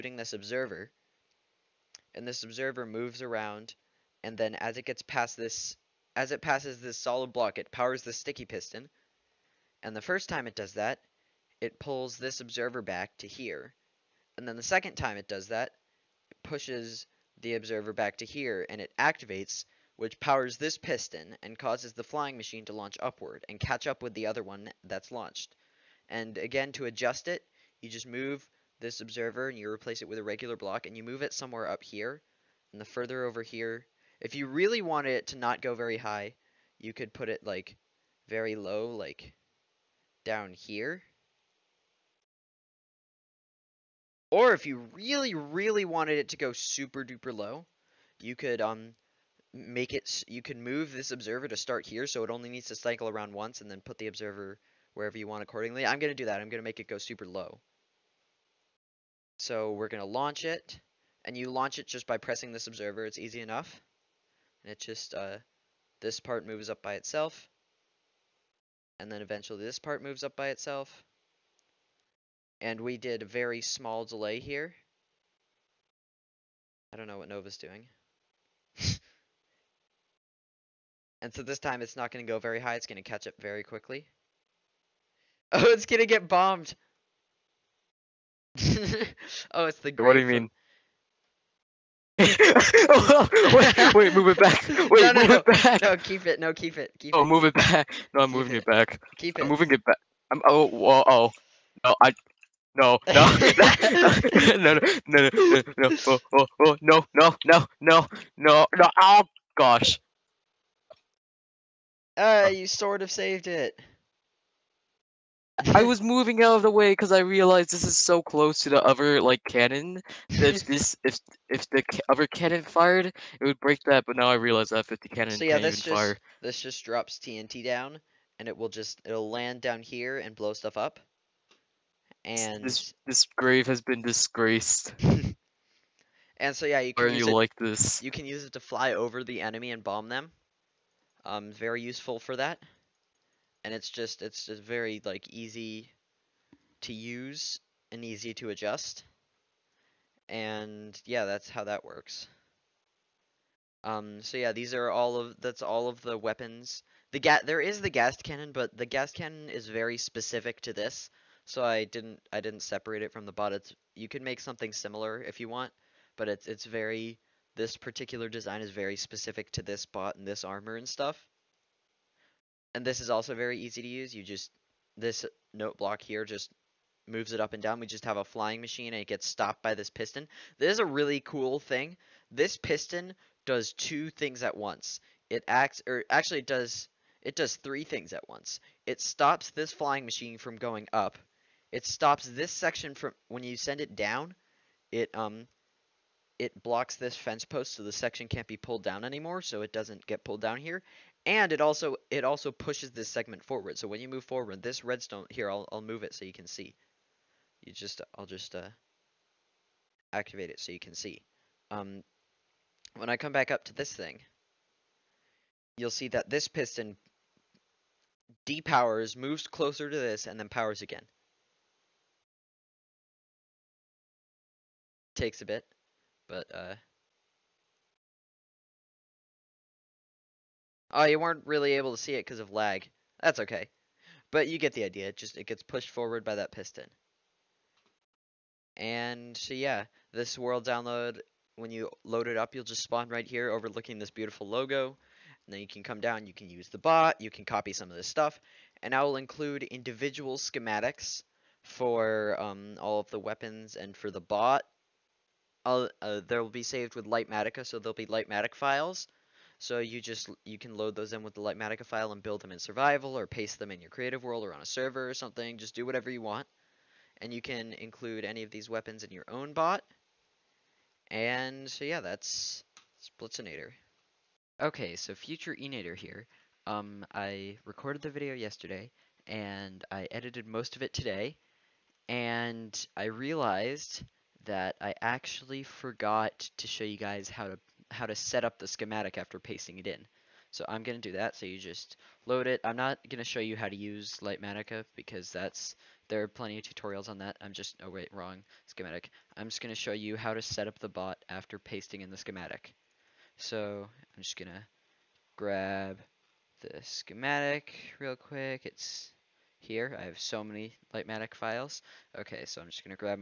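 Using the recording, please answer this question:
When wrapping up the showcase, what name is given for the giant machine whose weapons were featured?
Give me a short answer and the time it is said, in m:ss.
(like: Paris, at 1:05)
Blitzenator, at 4:33.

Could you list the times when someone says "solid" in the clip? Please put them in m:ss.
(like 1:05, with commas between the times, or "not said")
0:06.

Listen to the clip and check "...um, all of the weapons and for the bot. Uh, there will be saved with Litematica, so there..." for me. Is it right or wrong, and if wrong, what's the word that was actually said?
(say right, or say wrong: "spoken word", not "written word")
right.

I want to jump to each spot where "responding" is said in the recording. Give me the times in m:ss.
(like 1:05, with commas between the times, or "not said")
not said.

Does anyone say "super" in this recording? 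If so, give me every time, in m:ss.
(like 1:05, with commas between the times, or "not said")
0:46, 0:56.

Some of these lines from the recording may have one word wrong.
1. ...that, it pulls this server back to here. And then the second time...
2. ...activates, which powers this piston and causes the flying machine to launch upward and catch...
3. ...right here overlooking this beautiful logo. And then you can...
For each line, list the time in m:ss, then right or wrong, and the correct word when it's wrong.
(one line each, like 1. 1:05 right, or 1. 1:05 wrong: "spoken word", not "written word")
1. 0:10 wrong: "observer", not "server"
2. 0:18 right
3. 4:03 right.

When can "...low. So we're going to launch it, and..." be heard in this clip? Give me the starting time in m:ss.
0:57.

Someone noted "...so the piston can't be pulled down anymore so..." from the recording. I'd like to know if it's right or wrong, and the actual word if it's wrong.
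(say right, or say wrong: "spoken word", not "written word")
wrong: "section", not "piston".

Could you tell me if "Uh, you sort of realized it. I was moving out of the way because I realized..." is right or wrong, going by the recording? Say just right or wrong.
wrong.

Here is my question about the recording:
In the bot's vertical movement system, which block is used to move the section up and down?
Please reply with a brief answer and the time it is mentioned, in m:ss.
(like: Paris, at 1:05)
Note block, at 2:55.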